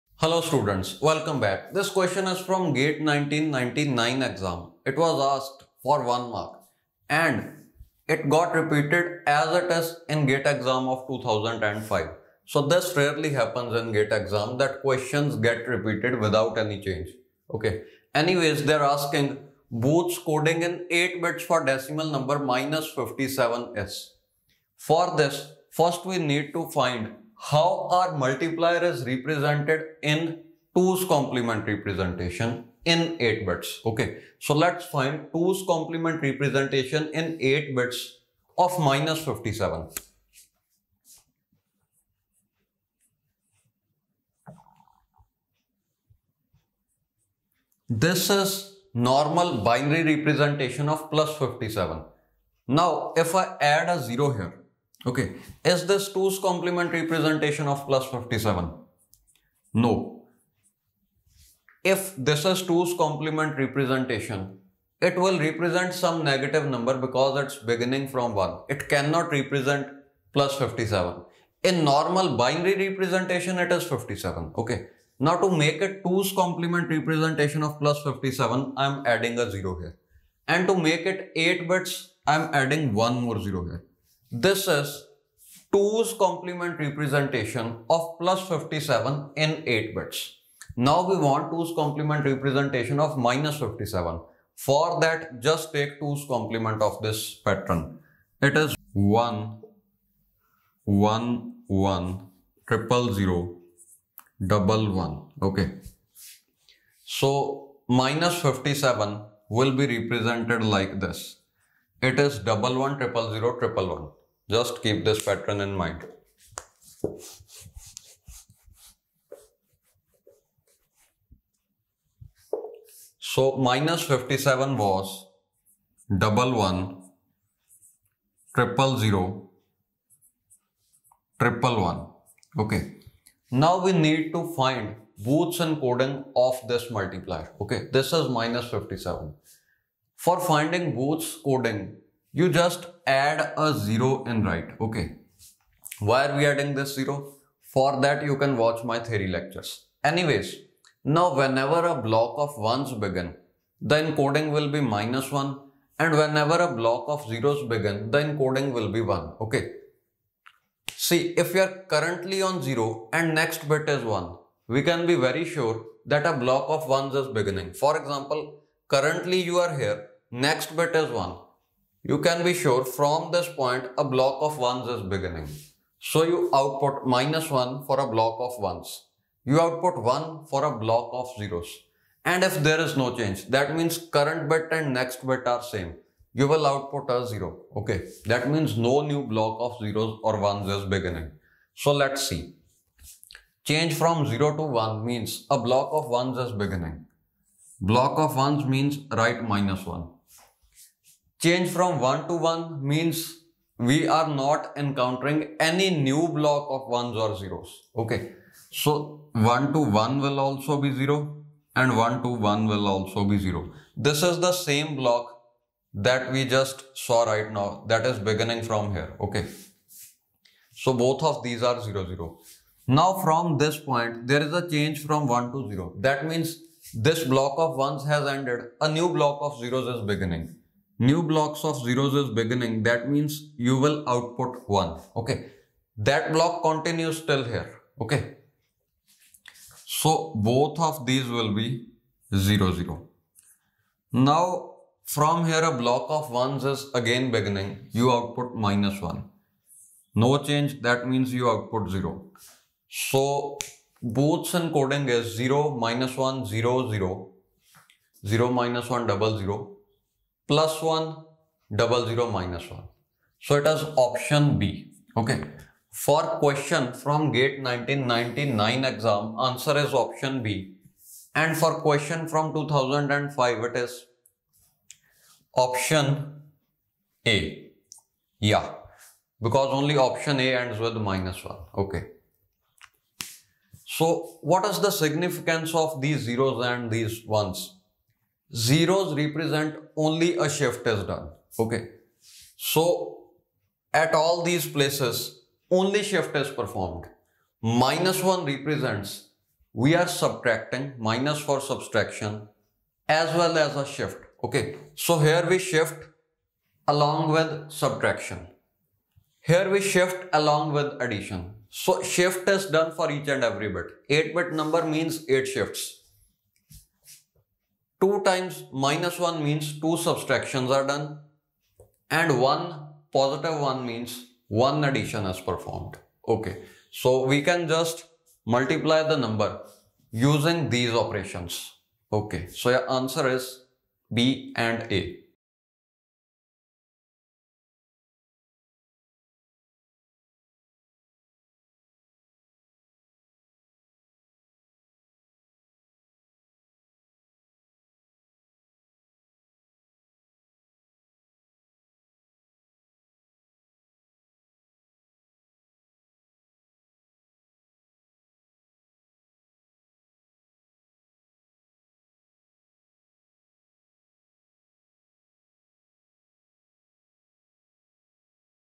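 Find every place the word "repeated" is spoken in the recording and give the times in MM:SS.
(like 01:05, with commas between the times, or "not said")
00:08, 00:15.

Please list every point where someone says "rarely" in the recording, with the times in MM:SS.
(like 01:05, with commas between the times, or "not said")
00:12.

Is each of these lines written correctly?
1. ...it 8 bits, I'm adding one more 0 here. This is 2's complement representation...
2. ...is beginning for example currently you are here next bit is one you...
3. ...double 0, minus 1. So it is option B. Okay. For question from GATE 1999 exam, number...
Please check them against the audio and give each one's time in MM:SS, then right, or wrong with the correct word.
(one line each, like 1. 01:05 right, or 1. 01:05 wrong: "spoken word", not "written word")
1. 01:21 right
2. 02:47 right
3. 04:21 wrong: "answer", not "number".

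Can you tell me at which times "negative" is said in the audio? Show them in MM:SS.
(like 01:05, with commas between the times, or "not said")
01:06.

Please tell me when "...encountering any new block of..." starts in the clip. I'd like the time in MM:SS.
03:24.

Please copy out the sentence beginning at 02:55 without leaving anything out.
So you output minus 1 for a block of 1s.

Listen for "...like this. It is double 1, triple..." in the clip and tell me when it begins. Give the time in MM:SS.
01:50.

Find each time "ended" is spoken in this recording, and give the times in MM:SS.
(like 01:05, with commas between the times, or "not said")
03:48.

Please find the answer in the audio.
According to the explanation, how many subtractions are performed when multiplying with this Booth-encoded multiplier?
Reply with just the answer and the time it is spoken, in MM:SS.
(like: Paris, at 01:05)
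2, at 05:19.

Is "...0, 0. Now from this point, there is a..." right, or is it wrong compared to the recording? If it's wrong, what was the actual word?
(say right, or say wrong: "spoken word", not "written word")
right.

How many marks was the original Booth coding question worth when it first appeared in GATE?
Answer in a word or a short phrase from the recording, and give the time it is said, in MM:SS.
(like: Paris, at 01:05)
1, at 00:06.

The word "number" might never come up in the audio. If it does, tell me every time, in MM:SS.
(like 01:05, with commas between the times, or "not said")
00:22, 01:06, 05:14, 05:29.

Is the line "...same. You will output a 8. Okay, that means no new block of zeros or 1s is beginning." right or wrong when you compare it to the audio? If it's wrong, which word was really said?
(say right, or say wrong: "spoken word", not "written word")
wrong: "0", not "8".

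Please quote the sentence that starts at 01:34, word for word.
For that, just take 2's complement of this pattern.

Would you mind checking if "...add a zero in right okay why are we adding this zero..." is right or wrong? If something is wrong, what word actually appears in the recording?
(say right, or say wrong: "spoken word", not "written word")
right.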